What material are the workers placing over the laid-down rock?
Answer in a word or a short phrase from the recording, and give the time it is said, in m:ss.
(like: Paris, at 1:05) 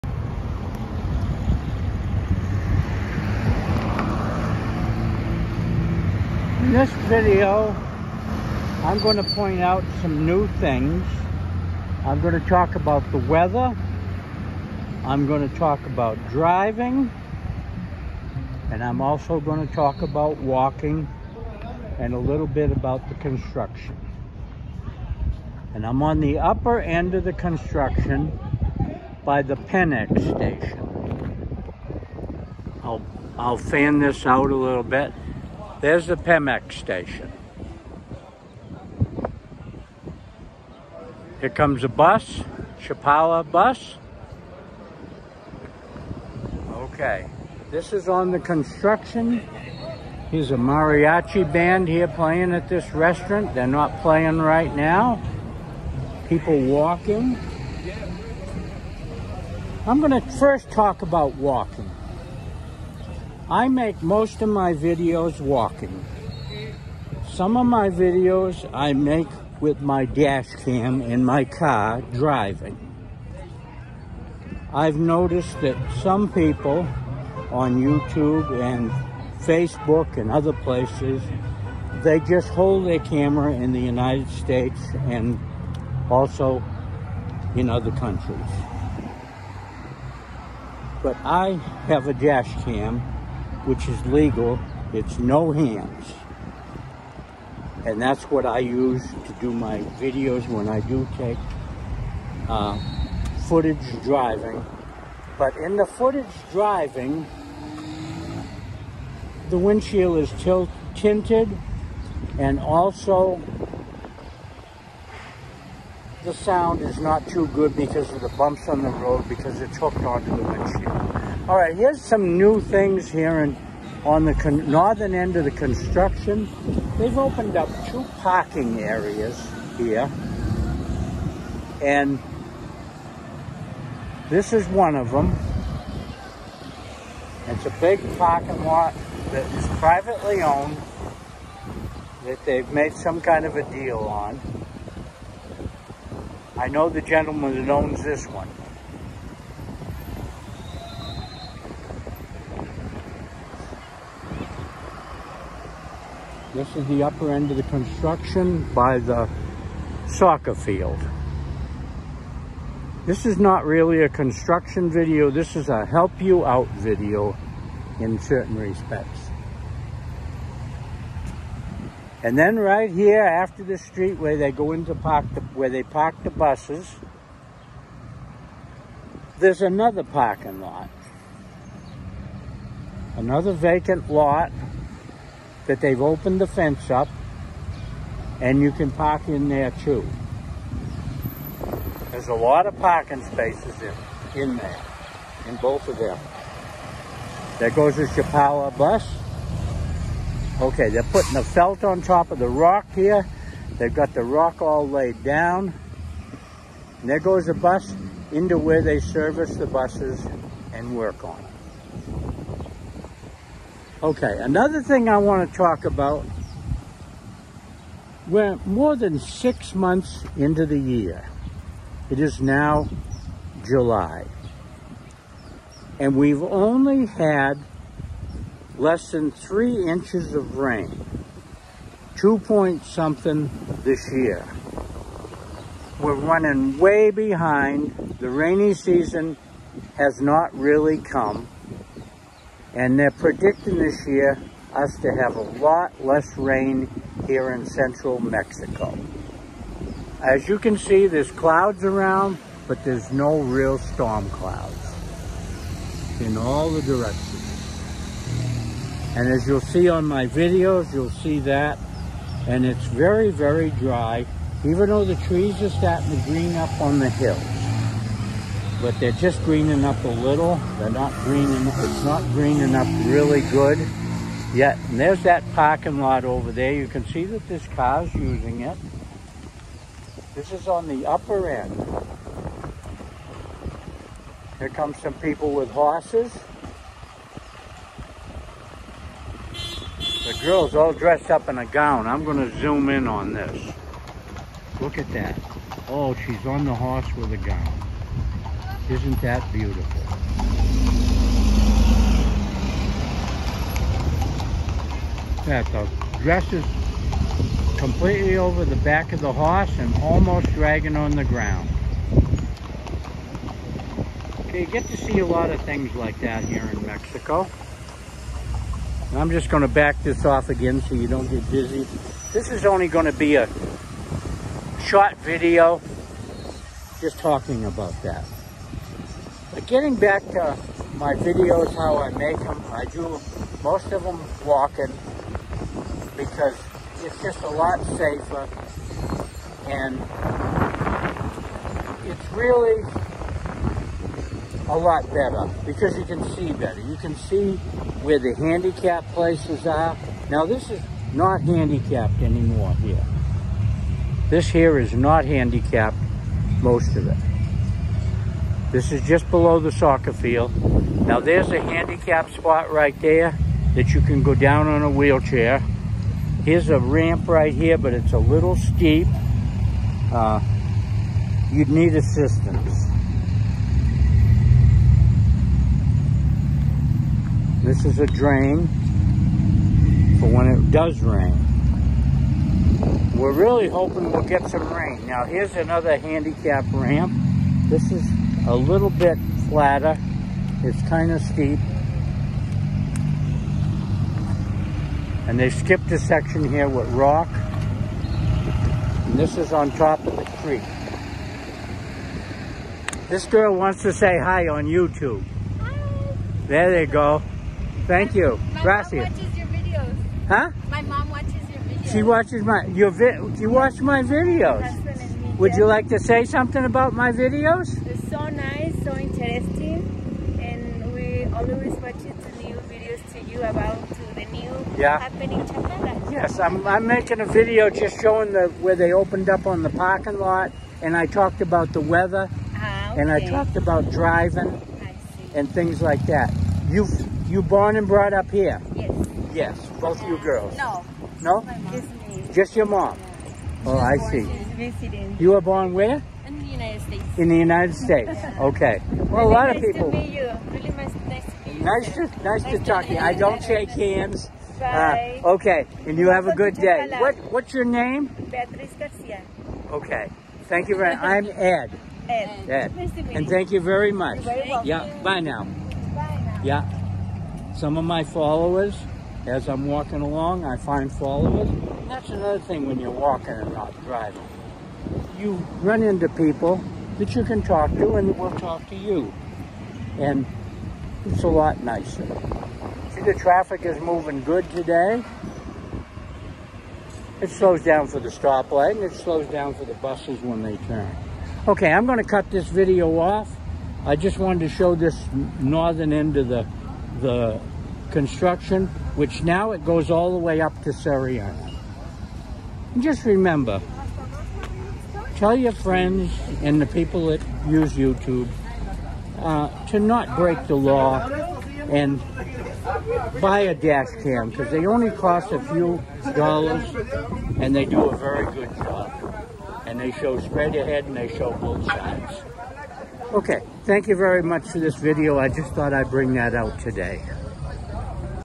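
felt, at 3:21.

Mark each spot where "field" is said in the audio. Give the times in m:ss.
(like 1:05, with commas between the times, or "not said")
2:40, 6:00.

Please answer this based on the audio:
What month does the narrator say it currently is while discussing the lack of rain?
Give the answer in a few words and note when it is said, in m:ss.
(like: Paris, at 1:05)
July, at 3:43.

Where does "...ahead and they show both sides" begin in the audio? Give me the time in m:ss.
8:40.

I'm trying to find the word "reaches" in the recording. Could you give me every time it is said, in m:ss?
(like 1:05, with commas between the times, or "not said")
not said.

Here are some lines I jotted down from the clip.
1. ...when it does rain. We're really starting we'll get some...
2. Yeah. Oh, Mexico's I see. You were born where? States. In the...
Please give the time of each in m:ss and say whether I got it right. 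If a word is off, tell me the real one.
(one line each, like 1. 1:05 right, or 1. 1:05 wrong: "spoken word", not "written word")
1. 6:20 wrong: "hoping", not "starting"
2. 7:22 wrong: "She", not "Mexico".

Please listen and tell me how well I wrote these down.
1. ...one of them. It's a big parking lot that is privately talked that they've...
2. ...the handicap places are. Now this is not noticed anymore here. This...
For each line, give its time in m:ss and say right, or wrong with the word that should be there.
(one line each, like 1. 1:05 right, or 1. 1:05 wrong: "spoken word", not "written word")
1. 2:14 wrong: "owned", not "talked"
2. 5:48 wrong: "handicapped", not "noticed".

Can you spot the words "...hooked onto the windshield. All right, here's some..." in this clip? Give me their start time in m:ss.
1:59.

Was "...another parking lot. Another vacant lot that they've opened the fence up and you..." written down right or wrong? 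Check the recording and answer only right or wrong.
right.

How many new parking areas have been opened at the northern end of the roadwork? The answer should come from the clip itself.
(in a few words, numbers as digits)
2.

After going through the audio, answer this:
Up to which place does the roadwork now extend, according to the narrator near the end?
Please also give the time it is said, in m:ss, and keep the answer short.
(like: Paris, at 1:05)
Seriana, at 8:20.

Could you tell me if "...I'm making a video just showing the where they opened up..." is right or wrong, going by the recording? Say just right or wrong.
right.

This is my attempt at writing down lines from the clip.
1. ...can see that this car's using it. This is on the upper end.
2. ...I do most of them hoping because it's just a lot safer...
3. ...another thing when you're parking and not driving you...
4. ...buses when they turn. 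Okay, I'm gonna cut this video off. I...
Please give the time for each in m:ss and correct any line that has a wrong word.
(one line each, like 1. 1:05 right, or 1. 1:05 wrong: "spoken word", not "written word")
1. 4:36 right
2. 5:32 wrong: "walking", not "hoping"
3. 7:52 wrong: "walking", not "parking"
4. 8:09 right.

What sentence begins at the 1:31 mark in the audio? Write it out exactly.
But I have a dash cam which is legal, it's no hands.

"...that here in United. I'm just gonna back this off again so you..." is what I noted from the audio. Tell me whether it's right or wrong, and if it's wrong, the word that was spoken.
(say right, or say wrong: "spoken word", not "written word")
wrong: "Mexico", not "United".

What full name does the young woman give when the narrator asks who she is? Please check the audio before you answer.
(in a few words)
Beatriz Garcia.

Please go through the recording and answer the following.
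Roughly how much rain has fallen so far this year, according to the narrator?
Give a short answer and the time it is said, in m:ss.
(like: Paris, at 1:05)
less than 3 inches, at 3:48.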